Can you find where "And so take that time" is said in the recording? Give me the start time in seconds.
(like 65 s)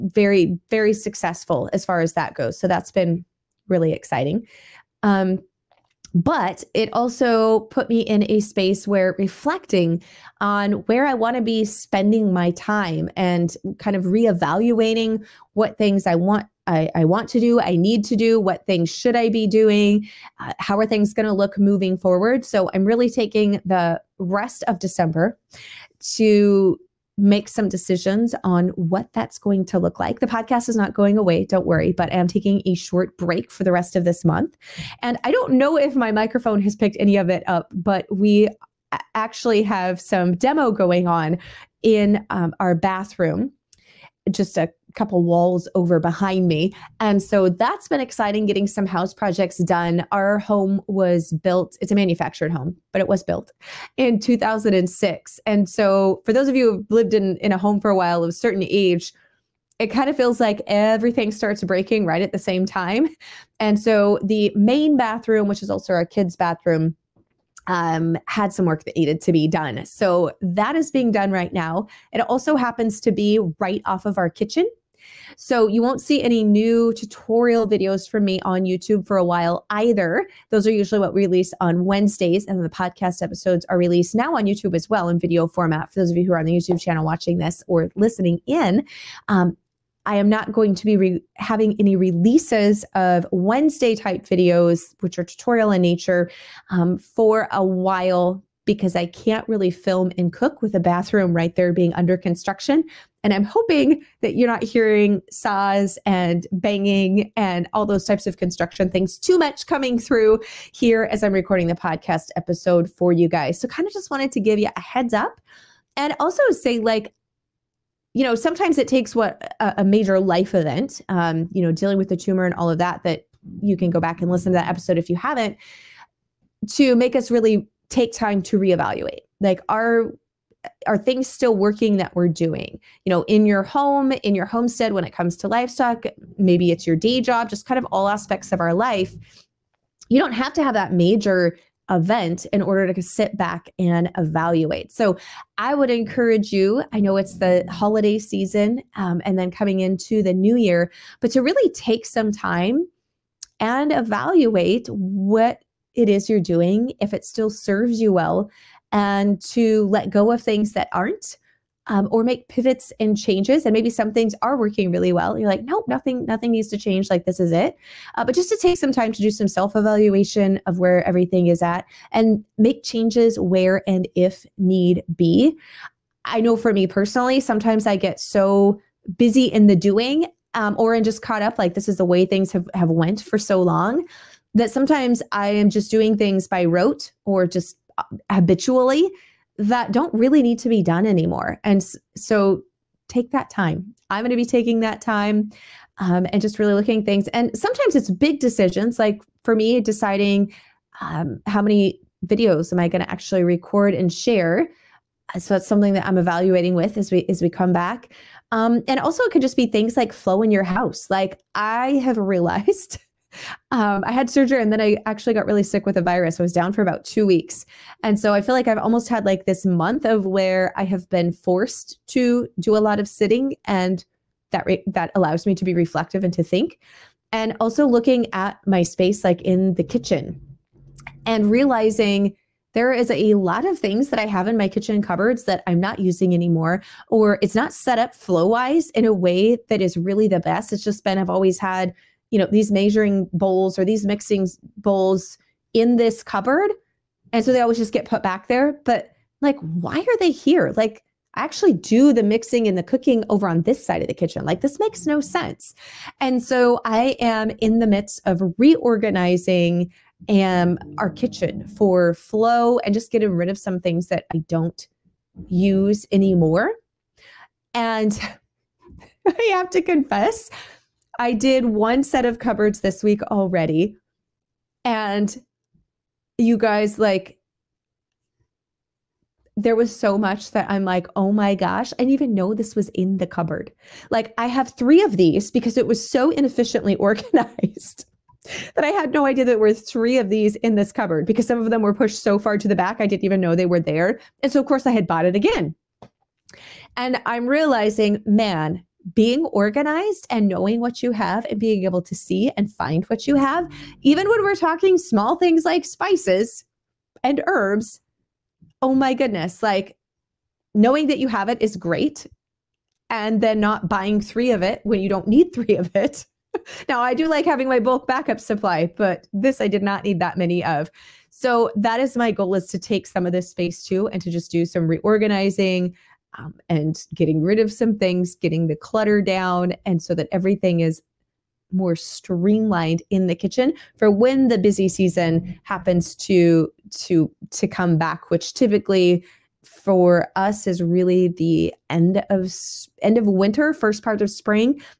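191 s.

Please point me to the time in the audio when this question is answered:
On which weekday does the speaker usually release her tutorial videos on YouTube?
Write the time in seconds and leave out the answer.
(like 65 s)
81 s.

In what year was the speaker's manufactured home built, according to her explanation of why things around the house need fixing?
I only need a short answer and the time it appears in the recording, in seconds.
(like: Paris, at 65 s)
2006, at 54 s.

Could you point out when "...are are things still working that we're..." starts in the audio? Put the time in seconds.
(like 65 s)
129 s.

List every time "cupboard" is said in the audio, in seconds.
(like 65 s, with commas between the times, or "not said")
235 s, 246 s, 272 s, 283 s, 290 s.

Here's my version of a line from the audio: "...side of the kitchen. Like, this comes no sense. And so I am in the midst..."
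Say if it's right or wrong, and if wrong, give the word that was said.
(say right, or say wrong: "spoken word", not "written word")
wrong: "makes", not "comes".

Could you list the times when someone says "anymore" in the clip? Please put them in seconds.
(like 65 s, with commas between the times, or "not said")
191 s, 236 s, 266 s.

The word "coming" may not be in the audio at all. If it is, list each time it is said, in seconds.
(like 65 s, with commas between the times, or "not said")
109 s, 149 s.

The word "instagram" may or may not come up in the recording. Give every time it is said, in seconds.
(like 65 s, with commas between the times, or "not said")
not said.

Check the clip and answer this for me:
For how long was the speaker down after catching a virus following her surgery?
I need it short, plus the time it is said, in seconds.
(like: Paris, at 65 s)
2 weeks, at 217 s.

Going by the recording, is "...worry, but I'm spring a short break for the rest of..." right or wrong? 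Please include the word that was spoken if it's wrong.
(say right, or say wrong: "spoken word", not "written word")
wrong: "taking", not "spring".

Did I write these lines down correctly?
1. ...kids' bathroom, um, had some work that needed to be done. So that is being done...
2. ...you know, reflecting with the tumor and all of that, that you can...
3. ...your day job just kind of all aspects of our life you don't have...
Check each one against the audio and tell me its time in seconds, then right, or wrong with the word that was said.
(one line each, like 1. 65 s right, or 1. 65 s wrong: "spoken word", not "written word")
1. 66 s right
2. 121 s wrong: "dealing", not "reflecting"
3. 136 s right.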